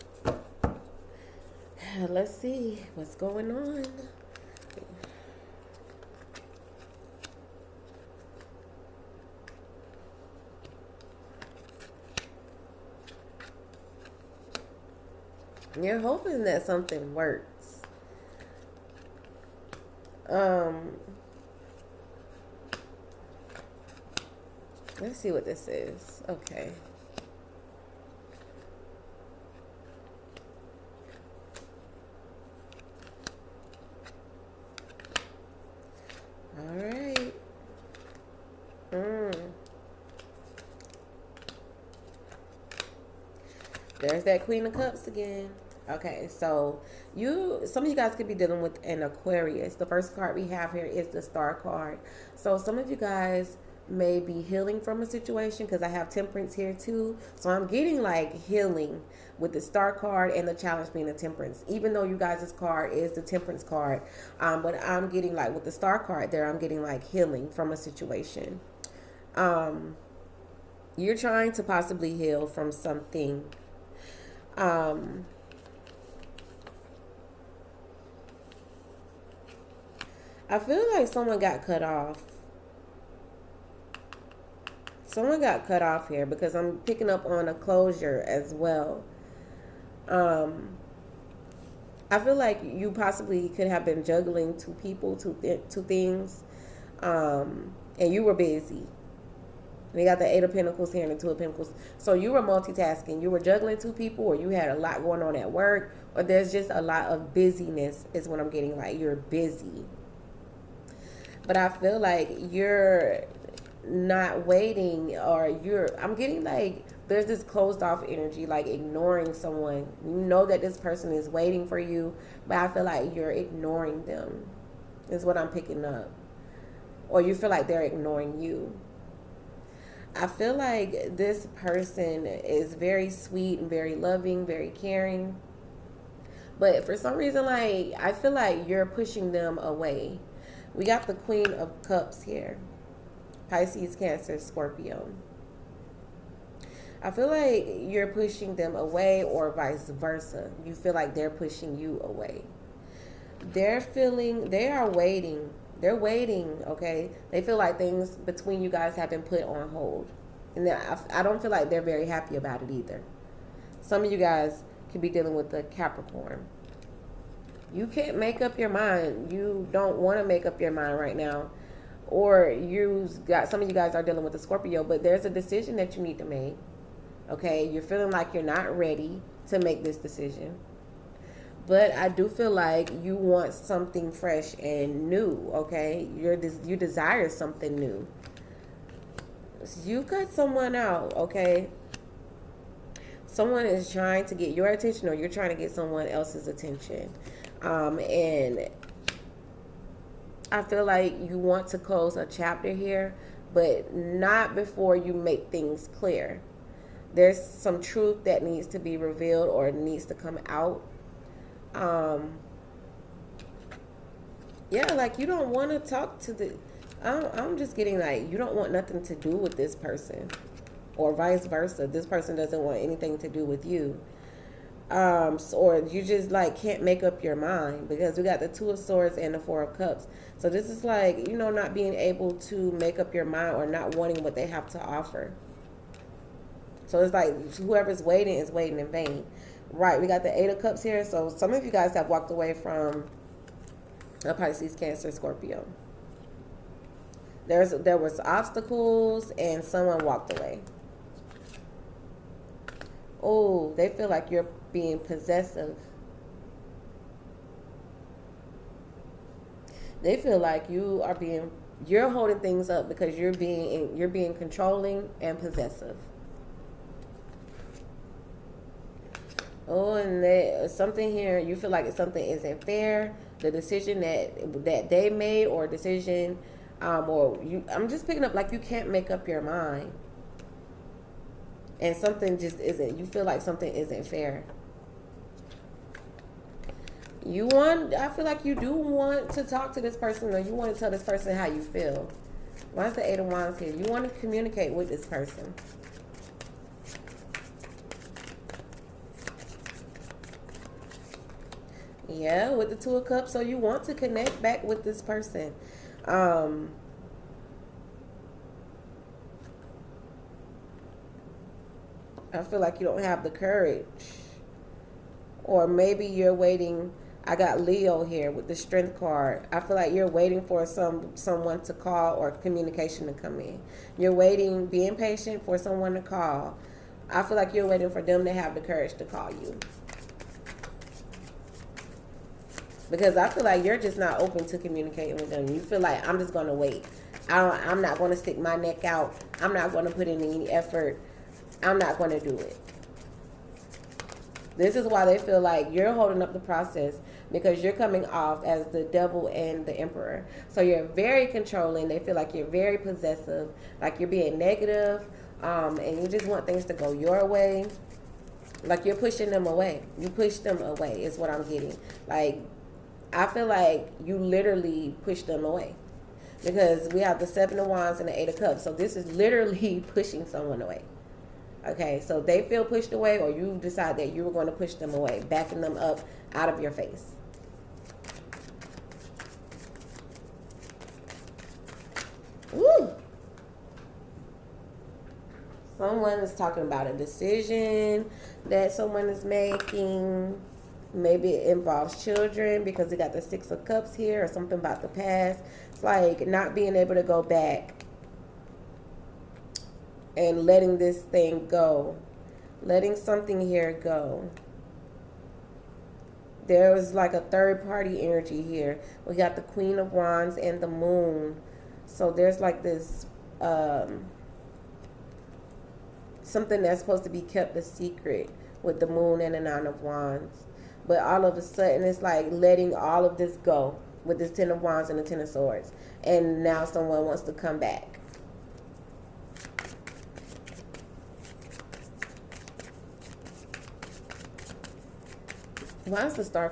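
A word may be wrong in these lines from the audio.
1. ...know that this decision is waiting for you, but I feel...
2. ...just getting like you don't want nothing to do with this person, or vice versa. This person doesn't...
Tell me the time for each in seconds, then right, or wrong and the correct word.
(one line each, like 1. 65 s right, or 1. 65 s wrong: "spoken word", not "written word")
1. 120 s wrong: "person", not "decision"
2. 217 s right.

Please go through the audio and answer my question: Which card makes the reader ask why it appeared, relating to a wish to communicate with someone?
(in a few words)
Eight of Wands.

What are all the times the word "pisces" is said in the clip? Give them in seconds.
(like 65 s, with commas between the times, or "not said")
143 s, 244 s.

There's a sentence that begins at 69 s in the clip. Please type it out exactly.
Um, you're trying to possibly heal from something.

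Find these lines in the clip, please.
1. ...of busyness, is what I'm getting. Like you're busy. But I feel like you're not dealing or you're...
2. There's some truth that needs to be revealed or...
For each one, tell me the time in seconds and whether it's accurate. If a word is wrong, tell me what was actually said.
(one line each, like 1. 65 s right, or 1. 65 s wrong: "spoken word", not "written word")
1. 107 s wrong: "waiting", not "dealing"
2. 207 s right.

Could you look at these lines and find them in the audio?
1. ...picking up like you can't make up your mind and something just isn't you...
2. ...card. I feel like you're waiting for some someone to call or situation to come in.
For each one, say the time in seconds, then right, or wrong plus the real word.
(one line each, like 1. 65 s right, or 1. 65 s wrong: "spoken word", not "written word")
1. 278 s right
2. 318 s wrong: "communication", not "situation".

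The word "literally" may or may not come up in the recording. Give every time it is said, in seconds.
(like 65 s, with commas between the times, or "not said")
364 s, 369 s.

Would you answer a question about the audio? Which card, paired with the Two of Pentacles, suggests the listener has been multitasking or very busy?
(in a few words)
Eight of Pentacles.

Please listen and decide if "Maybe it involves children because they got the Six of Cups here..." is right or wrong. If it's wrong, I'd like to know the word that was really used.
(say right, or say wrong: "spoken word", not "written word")
right.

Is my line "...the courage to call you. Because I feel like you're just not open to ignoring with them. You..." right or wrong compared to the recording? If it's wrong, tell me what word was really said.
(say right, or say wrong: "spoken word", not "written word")
wrong: "communicating", not "ignoring".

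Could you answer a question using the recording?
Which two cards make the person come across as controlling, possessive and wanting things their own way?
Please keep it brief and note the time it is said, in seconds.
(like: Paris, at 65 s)
The Devil and the Emperor, at 348 s.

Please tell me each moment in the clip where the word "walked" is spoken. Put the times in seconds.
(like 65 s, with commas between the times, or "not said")
242 s, 250 s.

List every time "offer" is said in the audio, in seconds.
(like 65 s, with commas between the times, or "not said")
234 s.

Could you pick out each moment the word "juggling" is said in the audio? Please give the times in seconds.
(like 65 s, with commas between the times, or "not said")
94 s, 103 s.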